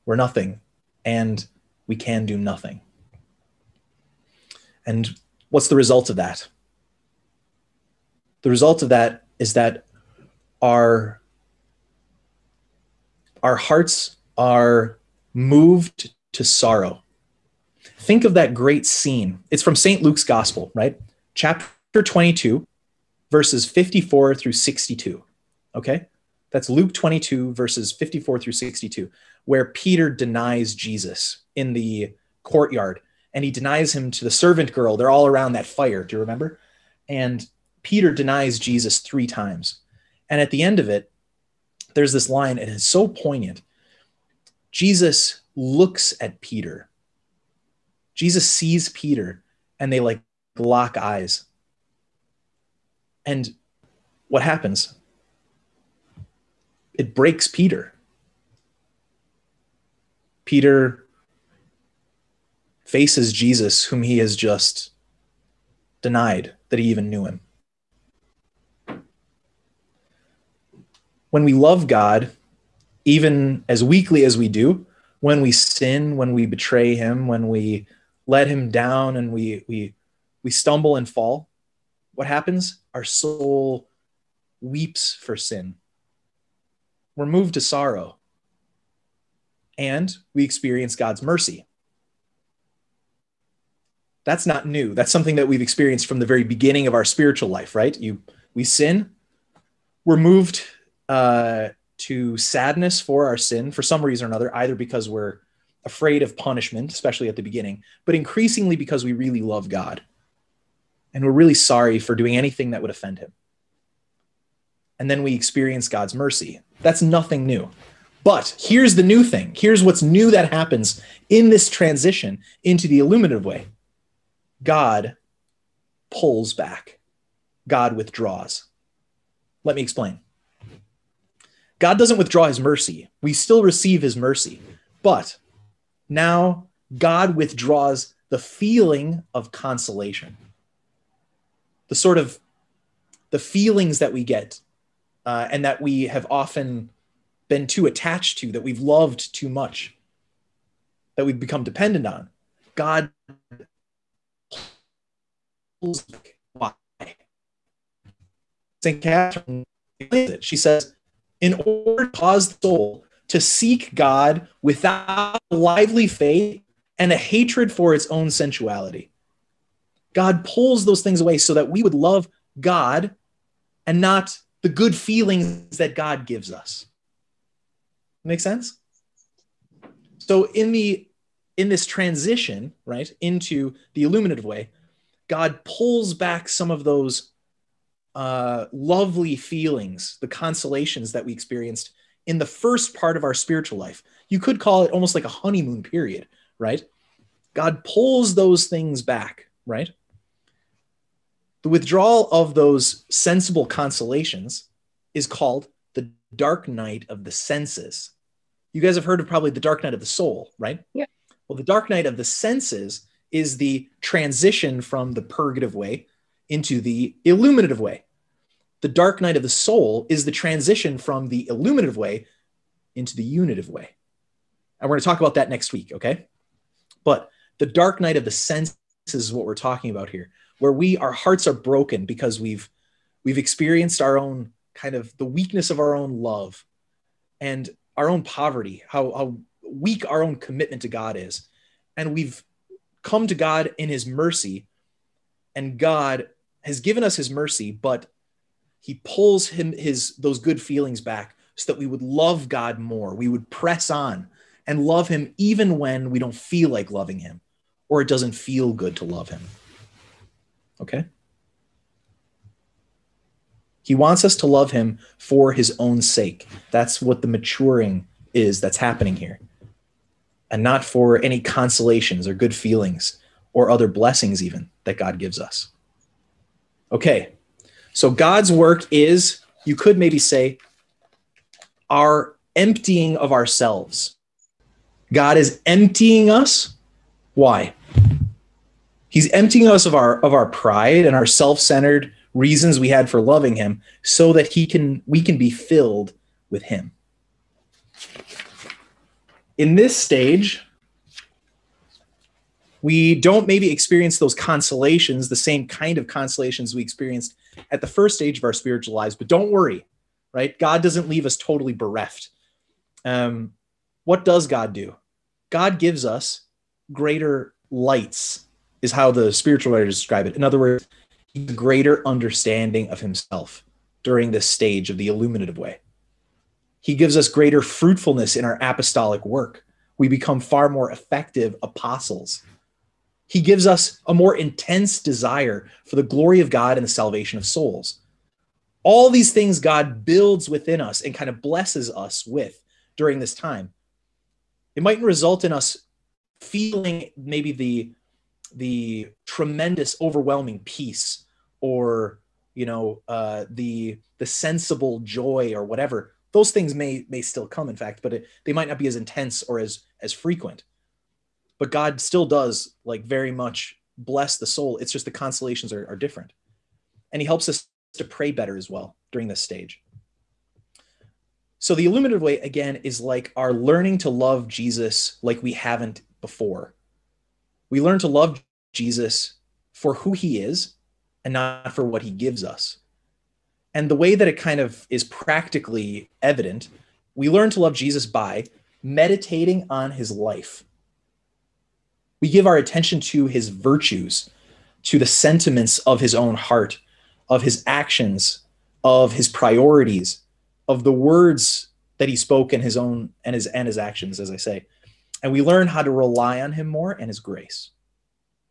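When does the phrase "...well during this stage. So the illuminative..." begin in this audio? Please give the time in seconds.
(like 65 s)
368 s.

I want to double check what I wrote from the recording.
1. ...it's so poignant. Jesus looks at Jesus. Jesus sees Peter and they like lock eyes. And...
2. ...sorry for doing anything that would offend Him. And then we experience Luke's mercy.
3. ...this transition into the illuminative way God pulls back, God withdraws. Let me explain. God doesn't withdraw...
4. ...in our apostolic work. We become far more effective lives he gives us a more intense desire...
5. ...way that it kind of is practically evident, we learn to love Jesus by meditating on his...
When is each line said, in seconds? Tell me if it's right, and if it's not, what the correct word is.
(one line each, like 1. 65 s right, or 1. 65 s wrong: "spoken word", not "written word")
1. 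42 s wrong: "Peter", not "Jesus"
2. 111 s wrong: "God", not "Luke"
3. 121 s right
4. 328 s wrong: "apostles", not "lives"
5. 383 s right.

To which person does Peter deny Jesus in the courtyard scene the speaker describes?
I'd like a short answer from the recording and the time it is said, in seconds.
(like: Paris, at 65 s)
The servant girl, at 34 s.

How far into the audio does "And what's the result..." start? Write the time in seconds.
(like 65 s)
4 s.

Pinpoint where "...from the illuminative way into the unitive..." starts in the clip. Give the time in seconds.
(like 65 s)
220 s.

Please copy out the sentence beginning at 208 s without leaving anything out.
You guys have heard of probably the dark night of the soul, right?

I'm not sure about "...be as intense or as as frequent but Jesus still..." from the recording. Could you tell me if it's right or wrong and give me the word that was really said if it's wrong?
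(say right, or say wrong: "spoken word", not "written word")
wrong: "God", not "Jesus".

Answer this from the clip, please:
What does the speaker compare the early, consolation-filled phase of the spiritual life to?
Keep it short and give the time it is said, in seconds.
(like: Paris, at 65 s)
A honeymoon period, at 195 s.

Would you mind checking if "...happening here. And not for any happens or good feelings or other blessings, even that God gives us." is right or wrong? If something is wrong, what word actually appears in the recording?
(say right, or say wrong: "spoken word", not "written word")
wrong: "consolations", not "happens".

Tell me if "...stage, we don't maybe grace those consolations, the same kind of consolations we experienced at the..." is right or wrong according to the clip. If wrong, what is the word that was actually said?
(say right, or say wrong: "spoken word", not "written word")
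wrong: "experience", not "grace".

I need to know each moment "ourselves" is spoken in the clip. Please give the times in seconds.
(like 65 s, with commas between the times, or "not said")
283 s.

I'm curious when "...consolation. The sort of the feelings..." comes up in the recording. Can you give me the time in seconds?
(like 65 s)
139 s.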